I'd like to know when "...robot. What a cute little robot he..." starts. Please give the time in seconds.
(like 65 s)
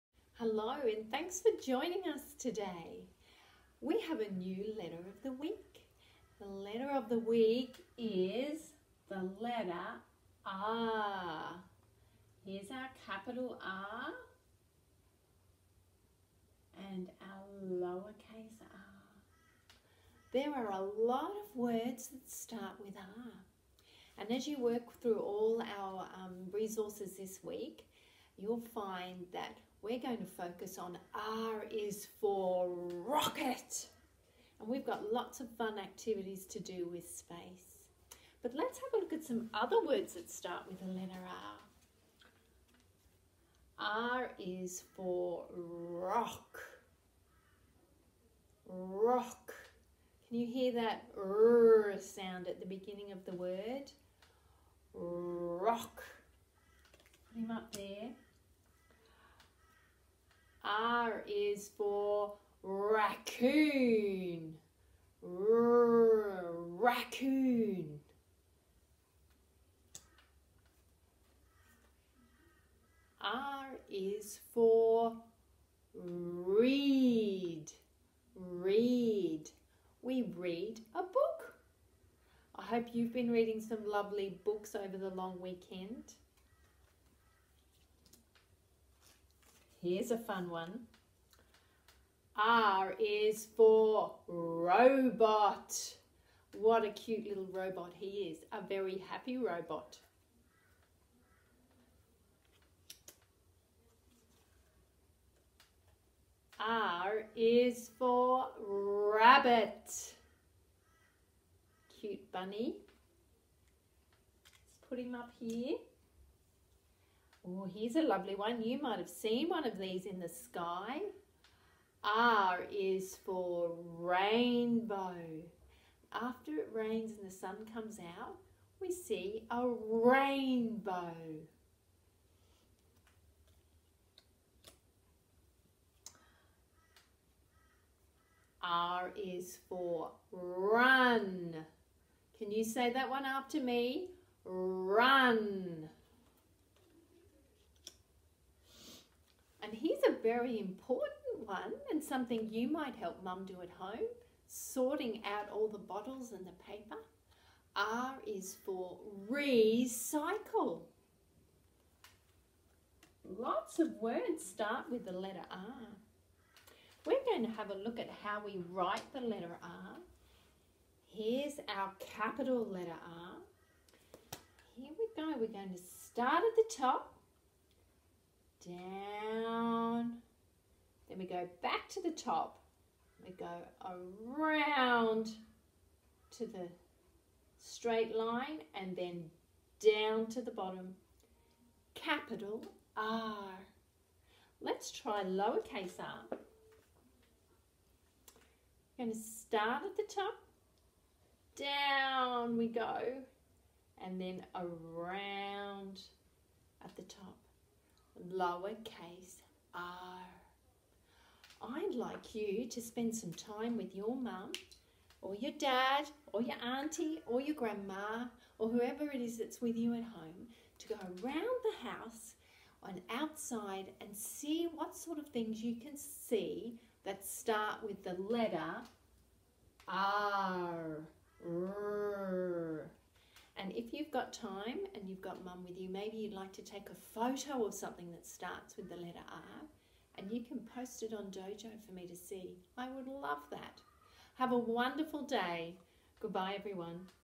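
94 s.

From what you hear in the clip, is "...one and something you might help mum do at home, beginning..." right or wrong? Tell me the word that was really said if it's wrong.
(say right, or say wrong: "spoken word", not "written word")
wrong: "sorting", not "beginning".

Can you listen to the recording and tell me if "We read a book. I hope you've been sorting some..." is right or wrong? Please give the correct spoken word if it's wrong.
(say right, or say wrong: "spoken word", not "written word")
wrong: "reading", not "sorting".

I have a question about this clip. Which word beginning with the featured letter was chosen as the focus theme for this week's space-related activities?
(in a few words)
rocket.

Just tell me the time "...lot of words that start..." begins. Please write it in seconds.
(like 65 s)
20 s.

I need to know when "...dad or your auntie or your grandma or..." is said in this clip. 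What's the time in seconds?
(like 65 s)
215 s.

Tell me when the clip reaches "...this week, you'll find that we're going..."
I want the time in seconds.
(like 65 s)
27 s.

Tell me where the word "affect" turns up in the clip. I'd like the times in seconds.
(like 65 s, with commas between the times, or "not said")
not said.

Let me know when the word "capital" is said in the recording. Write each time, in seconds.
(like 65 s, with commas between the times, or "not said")
13 s, 171 s, 191 s.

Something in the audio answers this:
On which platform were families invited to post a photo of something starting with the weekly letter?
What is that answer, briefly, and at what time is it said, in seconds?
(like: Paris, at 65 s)
Dojo, at 241 s.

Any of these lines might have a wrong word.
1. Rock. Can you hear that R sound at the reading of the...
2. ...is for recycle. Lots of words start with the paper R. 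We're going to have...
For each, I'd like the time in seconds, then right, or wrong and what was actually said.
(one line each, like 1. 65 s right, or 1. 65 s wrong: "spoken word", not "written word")
1. 48 s wrong: "beginning", not "reading"
2. 158 s wrong: "letter", not "paper".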